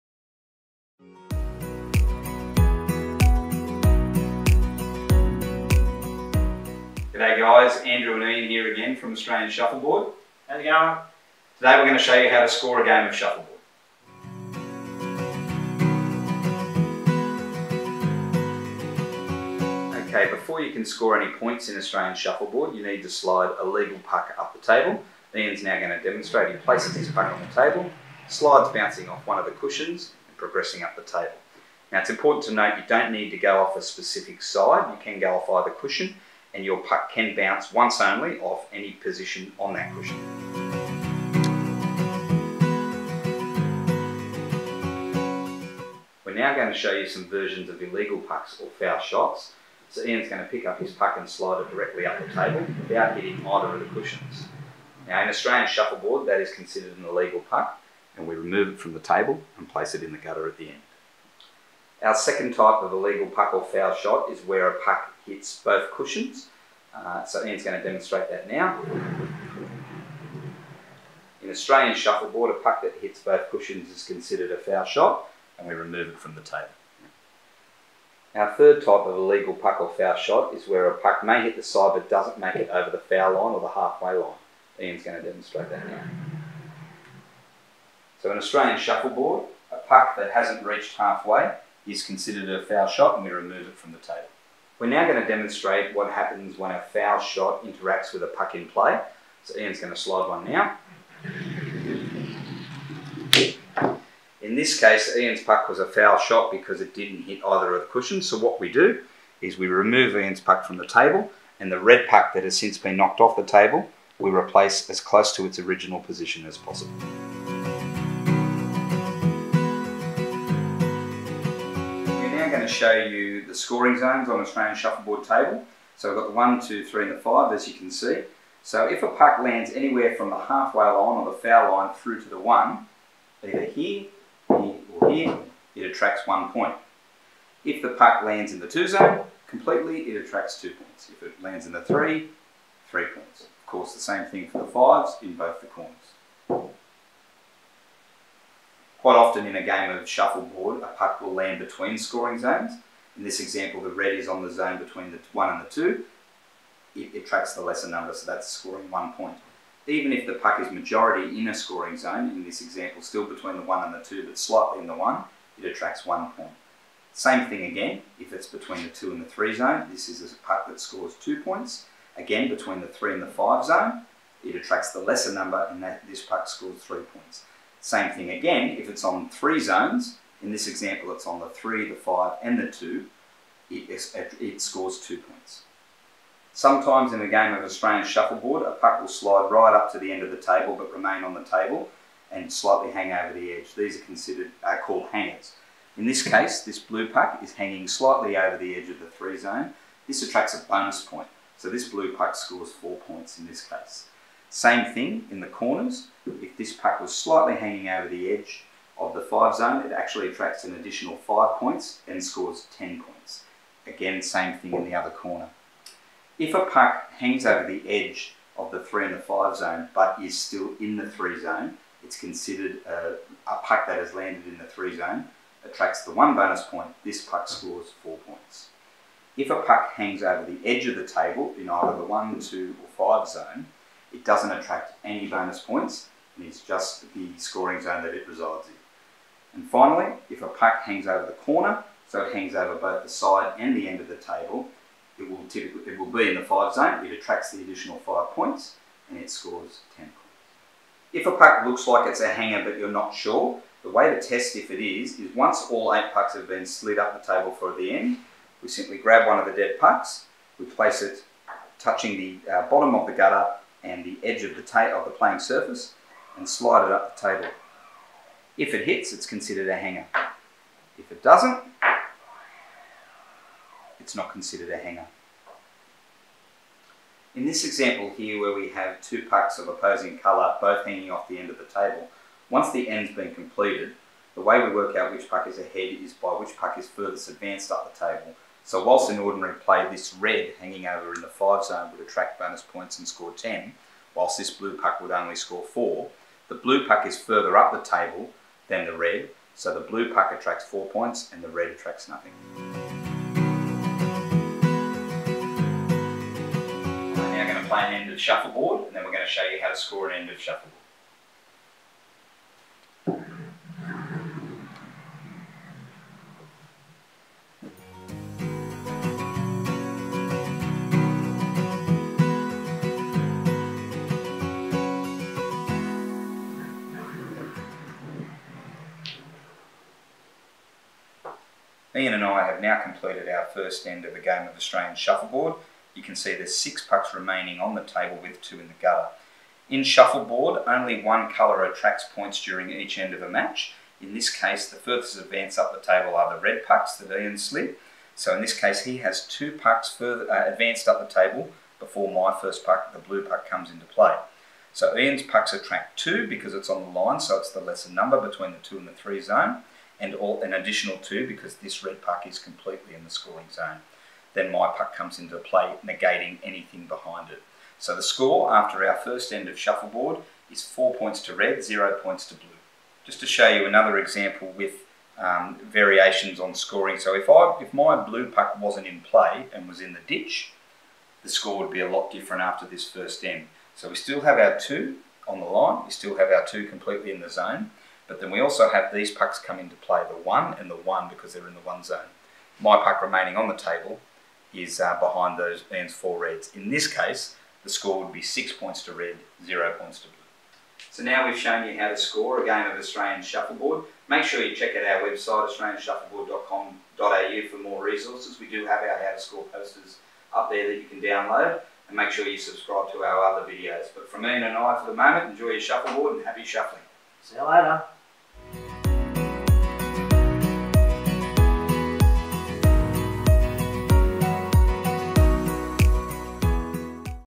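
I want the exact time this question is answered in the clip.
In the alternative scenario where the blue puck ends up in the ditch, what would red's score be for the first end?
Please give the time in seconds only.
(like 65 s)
398 s.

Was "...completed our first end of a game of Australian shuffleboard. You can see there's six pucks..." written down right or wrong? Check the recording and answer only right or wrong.
right.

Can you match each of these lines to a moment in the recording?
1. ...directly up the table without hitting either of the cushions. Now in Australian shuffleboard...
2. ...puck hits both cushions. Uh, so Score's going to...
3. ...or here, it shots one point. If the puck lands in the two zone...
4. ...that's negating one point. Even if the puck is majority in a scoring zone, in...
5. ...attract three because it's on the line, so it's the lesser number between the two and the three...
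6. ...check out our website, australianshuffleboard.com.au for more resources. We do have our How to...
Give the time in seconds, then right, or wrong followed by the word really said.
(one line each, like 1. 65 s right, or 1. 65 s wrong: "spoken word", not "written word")
1. 51 s right
2. 64 s wrong: "Ian", not "Score"
3. 134 s wrong: "attracts", not "shots"
4. 158 s wrong: "scoring", not "negating"
5. 355 s wrong: "two", not "three"
6. 404 s right.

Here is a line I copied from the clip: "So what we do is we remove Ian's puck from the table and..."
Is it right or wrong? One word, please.
right.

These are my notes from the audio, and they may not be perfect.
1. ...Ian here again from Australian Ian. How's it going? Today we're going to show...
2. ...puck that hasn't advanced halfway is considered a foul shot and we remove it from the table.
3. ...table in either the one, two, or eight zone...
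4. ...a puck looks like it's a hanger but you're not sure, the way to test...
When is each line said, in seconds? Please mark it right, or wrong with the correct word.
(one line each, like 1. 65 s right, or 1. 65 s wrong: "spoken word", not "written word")
1. 8 s wrong: "Shuffleboard", not "Ian"
2. 89 s wrong: "reached", not "advanced"
3. 231 s wrong: "five", not "eight"
4. 251 s right.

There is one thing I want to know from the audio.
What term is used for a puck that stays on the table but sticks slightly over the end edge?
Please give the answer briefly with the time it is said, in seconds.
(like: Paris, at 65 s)
hangers, at 195 s.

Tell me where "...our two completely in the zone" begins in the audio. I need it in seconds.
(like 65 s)
386 s.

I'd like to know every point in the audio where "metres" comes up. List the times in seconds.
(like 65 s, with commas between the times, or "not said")
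not said.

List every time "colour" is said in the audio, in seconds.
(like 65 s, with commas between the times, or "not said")
280 s, 341 s.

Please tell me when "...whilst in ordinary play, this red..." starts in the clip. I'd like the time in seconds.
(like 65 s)
288 s.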